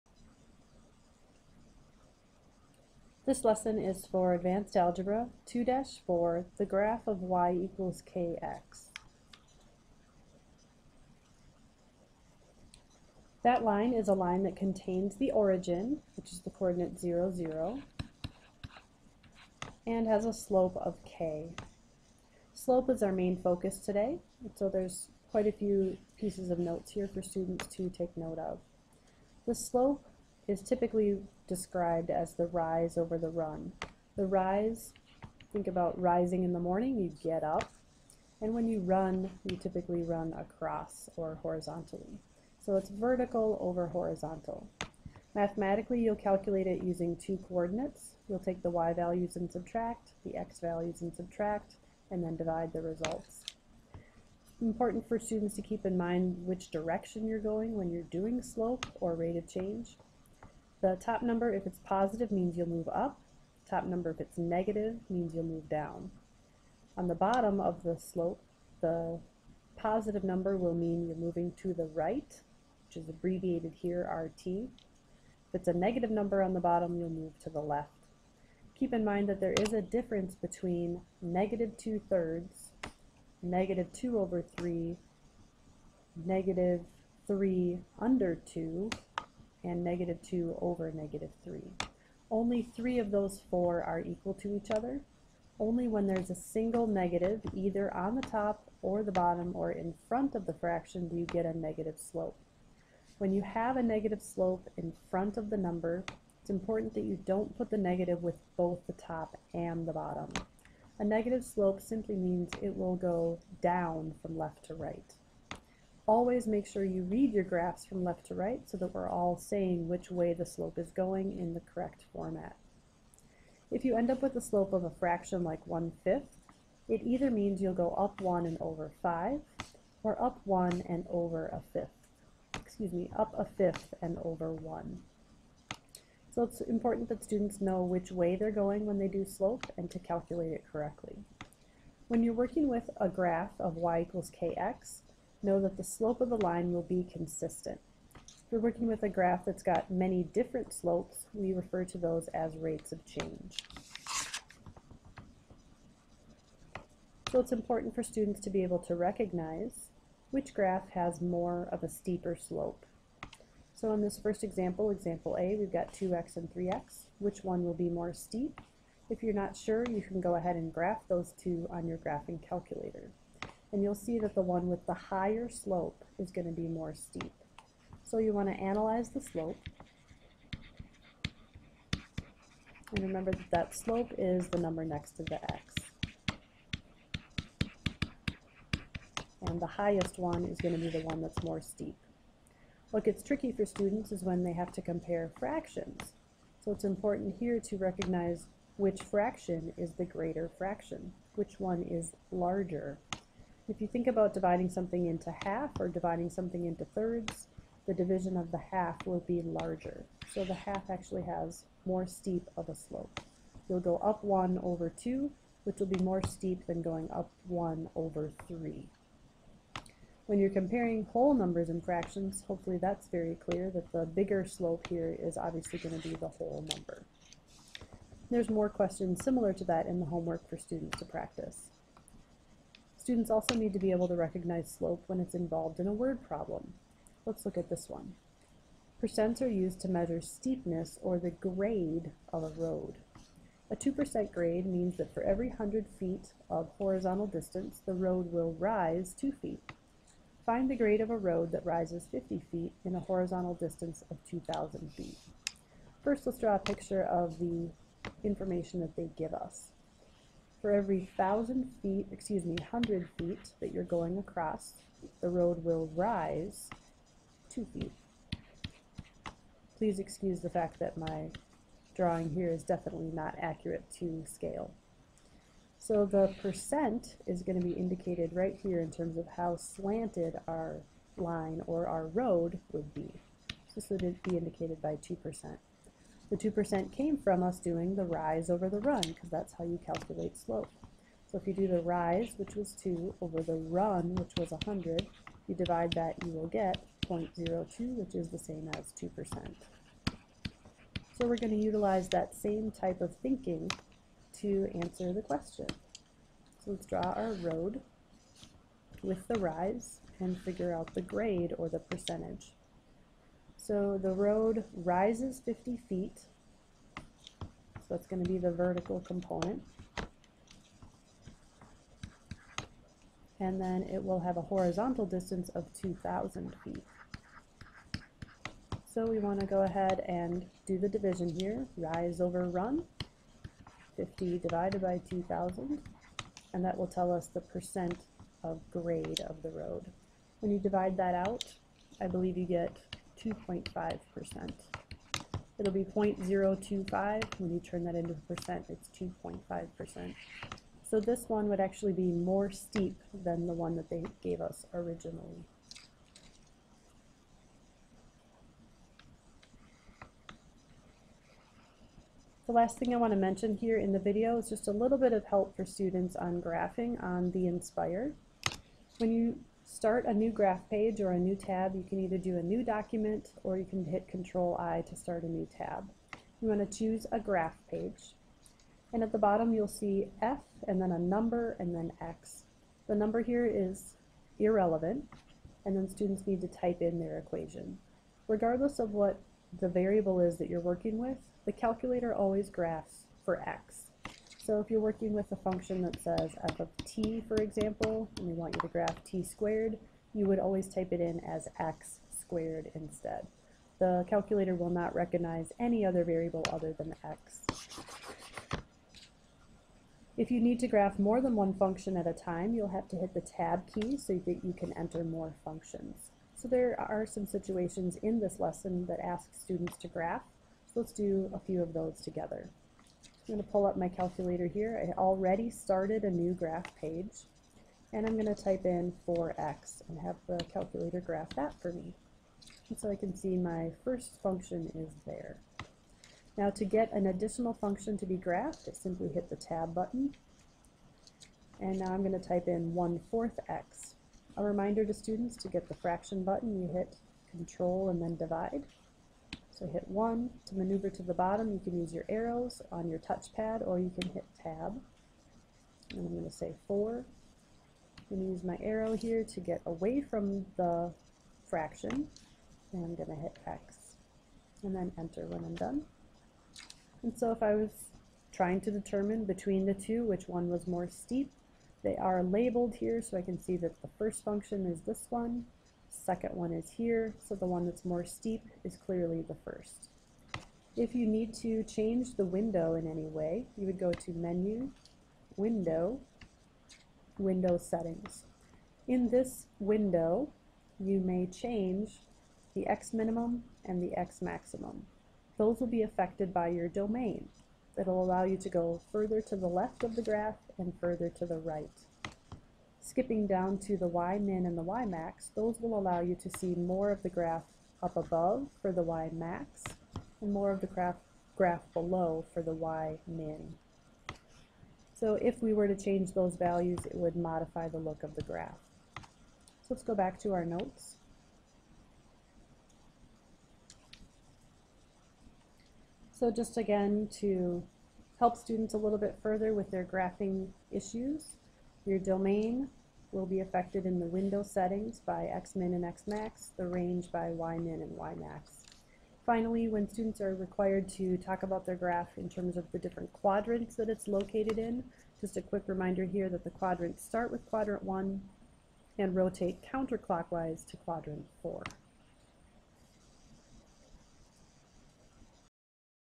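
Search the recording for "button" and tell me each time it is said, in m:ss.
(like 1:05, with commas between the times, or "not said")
7:19, 7:26.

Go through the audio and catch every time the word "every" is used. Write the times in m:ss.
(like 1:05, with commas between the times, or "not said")
4:05, 4:20.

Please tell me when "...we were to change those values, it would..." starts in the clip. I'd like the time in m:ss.
8:35.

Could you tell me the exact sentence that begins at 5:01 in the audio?
So we're going to utilize that same type of thinking to answer the question.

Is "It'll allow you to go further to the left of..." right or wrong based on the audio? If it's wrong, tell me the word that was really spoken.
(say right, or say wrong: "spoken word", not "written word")
right.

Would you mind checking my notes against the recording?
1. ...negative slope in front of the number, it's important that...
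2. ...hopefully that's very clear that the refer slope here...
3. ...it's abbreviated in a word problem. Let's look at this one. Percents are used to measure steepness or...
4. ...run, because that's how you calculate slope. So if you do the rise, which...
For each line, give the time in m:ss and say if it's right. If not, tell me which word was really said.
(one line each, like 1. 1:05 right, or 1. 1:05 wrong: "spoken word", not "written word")
1. 1:43 right
2. 3:42 wrong: "bigger", not "refer"
3. 3:55 wrong: "involved", not "abbreviated"
4. 4:48 right.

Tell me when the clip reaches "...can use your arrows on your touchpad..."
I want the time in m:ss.
7:31.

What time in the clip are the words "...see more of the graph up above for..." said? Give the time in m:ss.
8:26.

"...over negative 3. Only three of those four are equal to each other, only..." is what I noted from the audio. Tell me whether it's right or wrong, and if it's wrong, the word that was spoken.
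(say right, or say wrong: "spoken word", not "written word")
right.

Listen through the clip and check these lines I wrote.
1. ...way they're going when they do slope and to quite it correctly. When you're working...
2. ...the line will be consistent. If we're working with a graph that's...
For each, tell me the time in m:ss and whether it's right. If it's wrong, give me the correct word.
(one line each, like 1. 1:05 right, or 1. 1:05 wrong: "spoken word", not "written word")
1. 2:18 wrong: "calculate", not "quite"
2. 2:26 right.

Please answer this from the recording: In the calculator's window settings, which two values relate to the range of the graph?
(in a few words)
Ymin and Ymax.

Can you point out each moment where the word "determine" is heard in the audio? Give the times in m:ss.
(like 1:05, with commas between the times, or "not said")
7:48.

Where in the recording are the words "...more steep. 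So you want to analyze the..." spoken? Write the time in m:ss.
2:56.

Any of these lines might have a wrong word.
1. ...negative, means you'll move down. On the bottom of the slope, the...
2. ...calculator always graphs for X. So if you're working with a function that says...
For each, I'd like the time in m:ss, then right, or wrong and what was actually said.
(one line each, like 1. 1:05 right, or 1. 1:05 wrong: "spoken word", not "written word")
1. 1:04 right
2. 6:31 right.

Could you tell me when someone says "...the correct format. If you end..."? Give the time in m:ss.
2:01.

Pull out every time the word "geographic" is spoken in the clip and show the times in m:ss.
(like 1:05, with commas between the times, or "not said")
not said.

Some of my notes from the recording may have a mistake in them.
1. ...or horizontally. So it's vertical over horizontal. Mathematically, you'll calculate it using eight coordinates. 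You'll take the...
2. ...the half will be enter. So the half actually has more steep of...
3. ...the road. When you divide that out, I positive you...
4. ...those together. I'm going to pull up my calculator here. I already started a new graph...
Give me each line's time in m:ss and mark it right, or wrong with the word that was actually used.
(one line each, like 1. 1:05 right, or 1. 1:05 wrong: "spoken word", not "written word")
1. 0:41 wrong: "two", not "eight"
2. 3:28 wrong: "larger", not "enter"
3. 5:39 wrong: "believe", not "positive"
4. 7:01 right.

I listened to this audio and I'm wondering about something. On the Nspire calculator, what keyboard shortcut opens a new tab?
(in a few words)
Control I.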